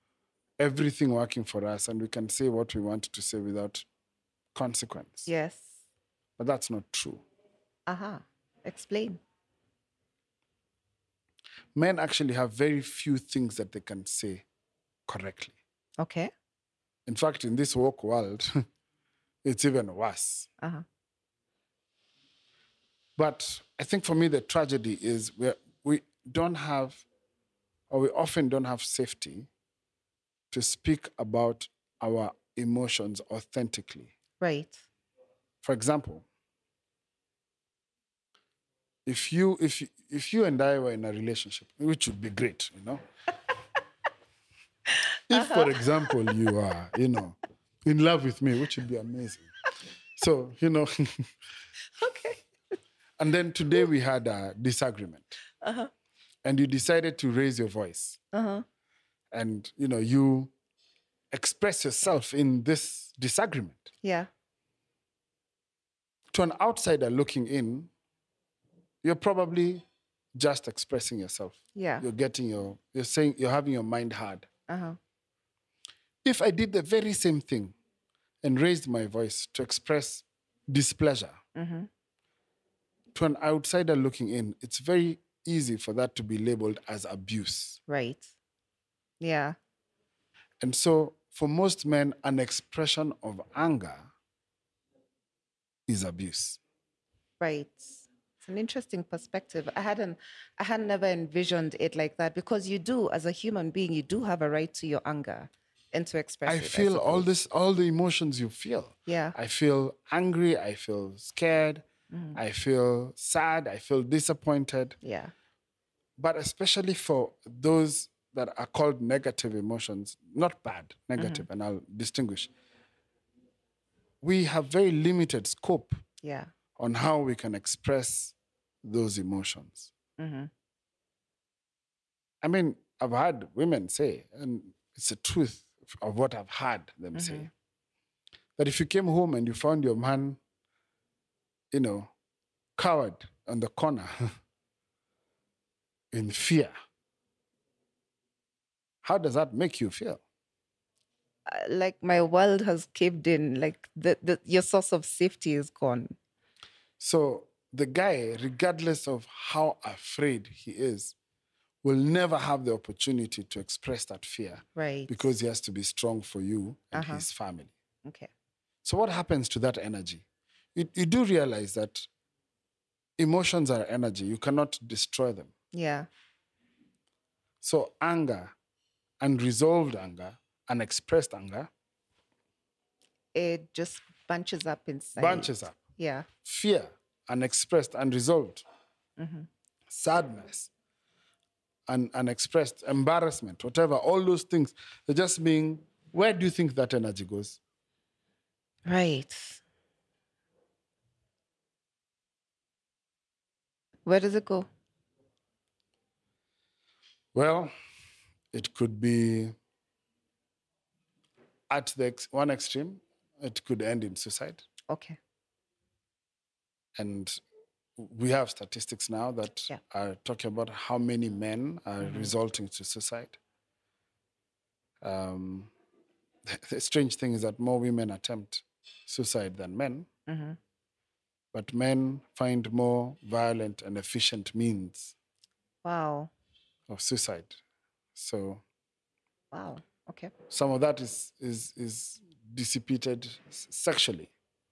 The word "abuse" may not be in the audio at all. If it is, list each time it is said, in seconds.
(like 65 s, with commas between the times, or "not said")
87 s, 96 s.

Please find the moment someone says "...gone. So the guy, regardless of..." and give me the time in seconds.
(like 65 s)
155 s.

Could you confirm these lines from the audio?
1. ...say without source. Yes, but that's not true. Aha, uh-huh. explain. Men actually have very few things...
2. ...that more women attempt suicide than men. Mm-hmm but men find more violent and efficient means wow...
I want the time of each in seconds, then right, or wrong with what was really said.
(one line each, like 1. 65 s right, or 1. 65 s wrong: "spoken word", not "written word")
1. 3 s wrong: "consequence", not "source"
2. 227 s right.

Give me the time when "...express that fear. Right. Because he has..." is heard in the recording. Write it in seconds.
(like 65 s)
163 s.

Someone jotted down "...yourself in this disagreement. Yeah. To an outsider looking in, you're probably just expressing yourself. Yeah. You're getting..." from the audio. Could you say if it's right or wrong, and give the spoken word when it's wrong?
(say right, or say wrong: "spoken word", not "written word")
right.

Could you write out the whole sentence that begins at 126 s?
on how we can express those emotions.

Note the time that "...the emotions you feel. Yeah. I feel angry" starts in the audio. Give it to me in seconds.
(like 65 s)
107 s.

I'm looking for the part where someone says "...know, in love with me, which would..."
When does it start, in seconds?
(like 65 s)
47 s.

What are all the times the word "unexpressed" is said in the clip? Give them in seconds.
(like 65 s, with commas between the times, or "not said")
180 s, 187 s, 192 s.